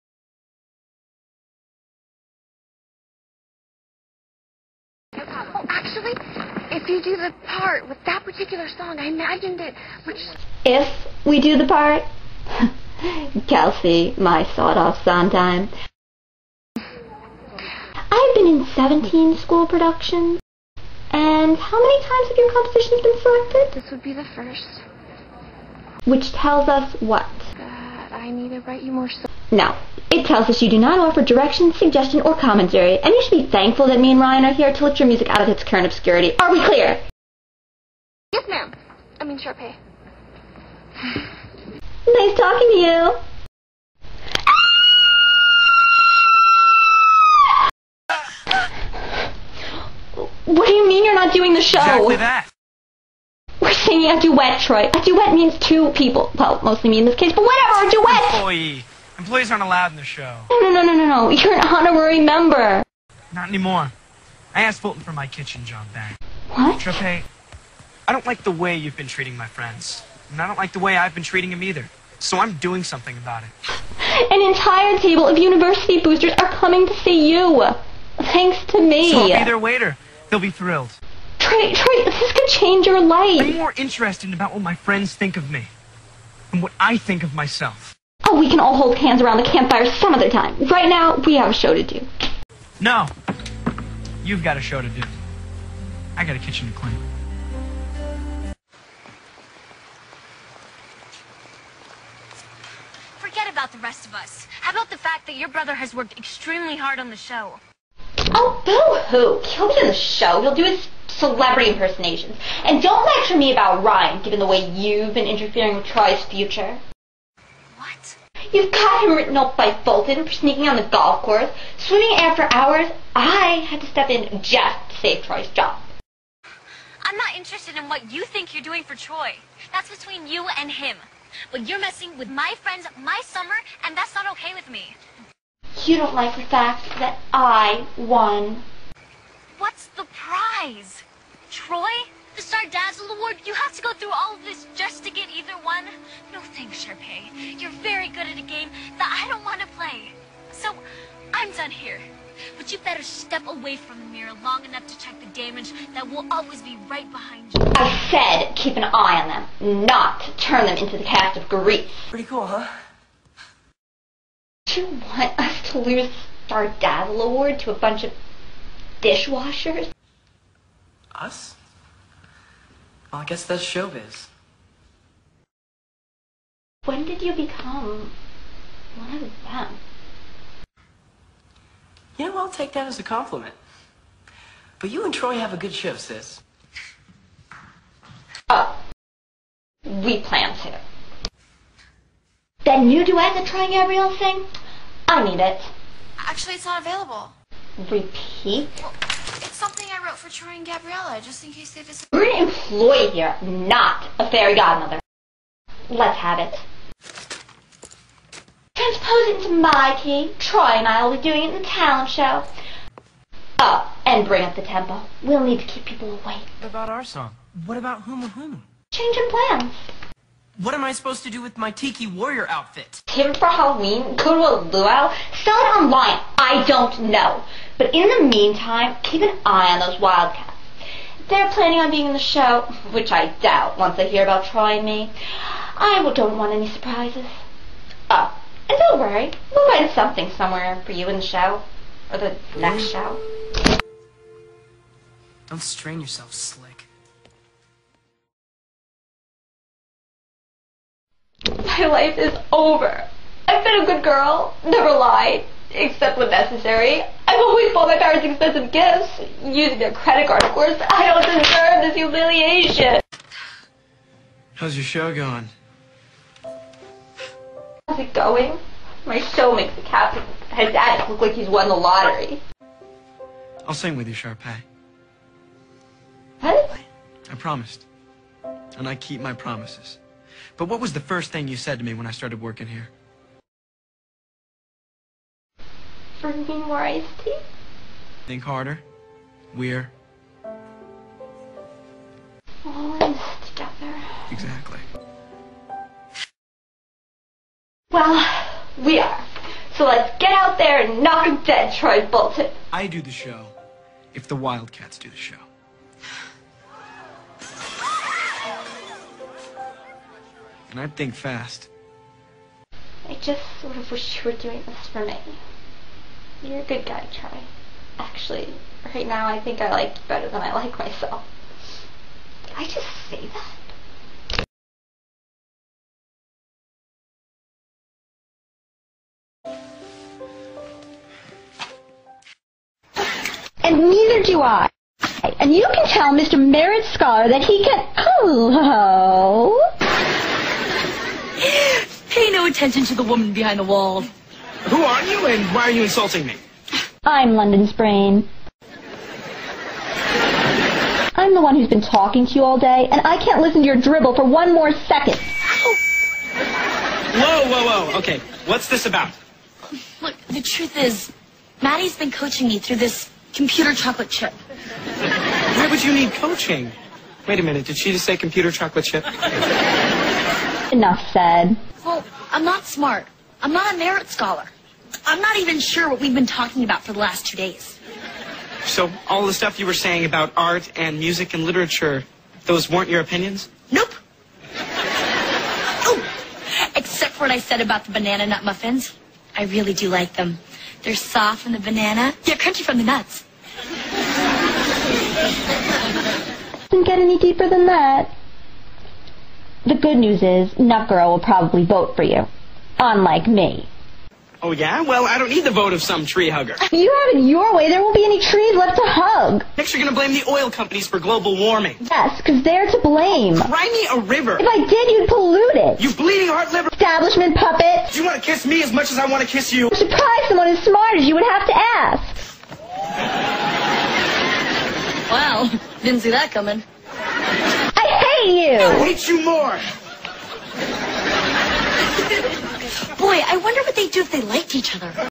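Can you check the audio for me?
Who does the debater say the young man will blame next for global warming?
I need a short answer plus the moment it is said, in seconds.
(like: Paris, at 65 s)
The oil companies, at 410 s.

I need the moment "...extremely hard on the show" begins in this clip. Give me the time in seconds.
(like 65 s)
106 s.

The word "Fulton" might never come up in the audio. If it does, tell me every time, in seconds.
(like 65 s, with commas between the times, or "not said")
64 s, 119 s.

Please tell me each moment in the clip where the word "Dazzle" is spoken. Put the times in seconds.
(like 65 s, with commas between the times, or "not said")
142 s, 166 s.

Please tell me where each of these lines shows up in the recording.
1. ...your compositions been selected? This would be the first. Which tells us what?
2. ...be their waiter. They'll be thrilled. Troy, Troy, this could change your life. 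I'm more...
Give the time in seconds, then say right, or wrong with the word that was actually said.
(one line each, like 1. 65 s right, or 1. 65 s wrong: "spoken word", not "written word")
1. 22 s right
2. 79 s right.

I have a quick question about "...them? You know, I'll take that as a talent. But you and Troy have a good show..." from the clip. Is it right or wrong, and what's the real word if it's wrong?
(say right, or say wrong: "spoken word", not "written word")
wrong: "compliment", not "talent".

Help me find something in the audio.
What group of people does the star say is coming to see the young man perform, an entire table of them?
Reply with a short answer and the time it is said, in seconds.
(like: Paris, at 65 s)
University boosters, at 75 s.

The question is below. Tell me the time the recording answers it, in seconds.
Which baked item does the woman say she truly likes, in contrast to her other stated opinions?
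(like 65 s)
387 s.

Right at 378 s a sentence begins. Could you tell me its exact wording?
So, all the stuff you were saying about art and music and literature, those weren't your opinions?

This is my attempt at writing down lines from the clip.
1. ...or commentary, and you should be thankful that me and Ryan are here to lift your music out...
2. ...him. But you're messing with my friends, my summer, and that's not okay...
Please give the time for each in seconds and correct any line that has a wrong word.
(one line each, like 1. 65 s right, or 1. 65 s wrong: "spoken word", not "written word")
1. 32 s right
2. 130 s right.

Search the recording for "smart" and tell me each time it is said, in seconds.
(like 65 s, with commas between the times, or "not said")
372 s, 420 s.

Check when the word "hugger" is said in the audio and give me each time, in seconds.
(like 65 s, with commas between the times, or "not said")
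406 s.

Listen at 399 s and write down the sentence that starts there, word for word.
The good news is, Nut Girl will probably vote for you unlike me.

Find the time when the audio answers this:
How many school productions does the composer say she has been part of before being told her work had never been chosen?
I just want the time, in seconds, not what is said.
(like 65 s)
18 s.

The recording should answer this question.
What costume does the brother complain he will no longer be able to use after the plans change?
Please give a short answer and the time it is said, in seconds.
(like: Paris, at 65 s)
Tiki Warrior outfit, at 221 s.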